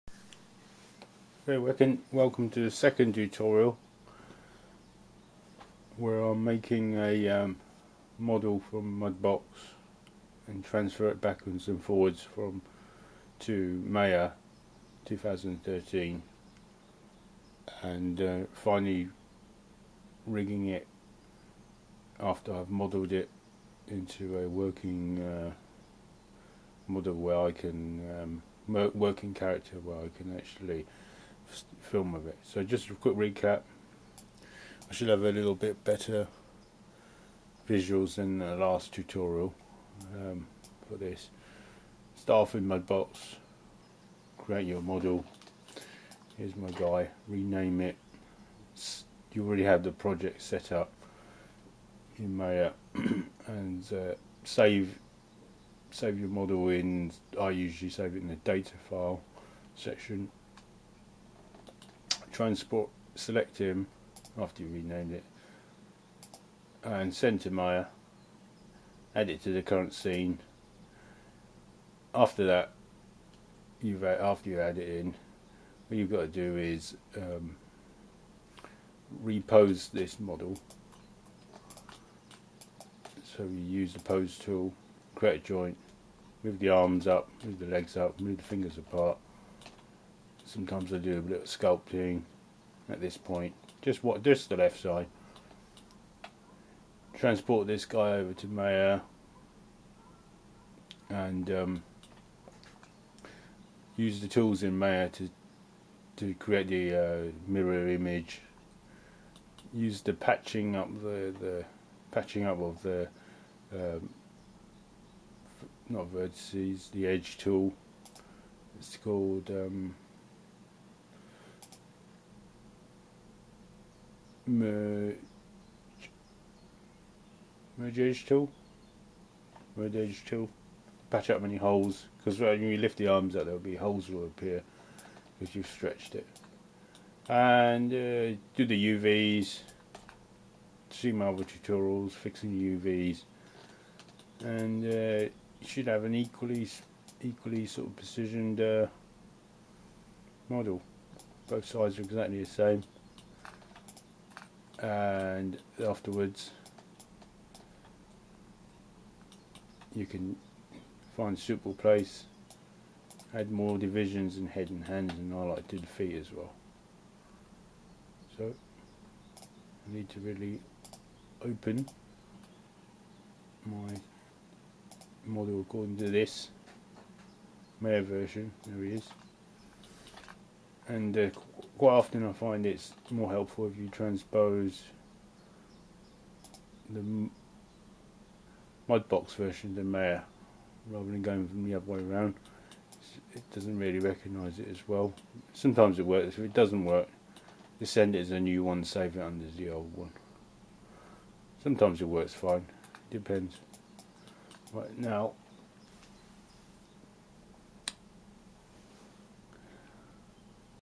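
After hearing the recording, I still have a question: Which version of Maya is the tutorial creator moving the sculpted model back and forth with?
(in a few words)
Maya 2013.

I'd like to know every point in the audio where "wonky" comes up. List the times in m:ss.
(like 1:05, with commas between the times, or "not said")
not said.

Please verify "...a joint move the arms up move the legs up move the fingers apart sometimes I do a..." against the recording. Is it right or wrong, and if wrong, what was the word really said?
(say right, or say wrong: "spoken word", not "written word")
right.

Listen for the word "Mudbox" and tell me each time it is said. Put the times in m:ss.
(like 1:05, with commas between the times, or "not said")
0:08, 0:42, 3:08.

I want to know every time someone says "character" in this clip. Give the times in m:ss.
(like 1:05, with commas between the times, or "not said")
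0:29.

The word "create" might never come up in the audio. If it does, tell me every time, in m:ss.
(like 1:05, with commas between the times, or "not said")
0:44, 1:25, 1:46.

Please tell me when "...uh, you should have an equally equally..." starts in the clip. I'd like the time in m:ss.
2:24.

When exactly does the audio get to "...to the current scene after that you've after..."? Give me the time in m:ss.
1:09.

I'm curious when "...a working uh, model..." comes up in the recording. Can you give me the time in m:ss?
0:24.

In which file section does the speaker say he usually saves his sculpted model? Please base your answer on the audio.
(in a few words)
data file section.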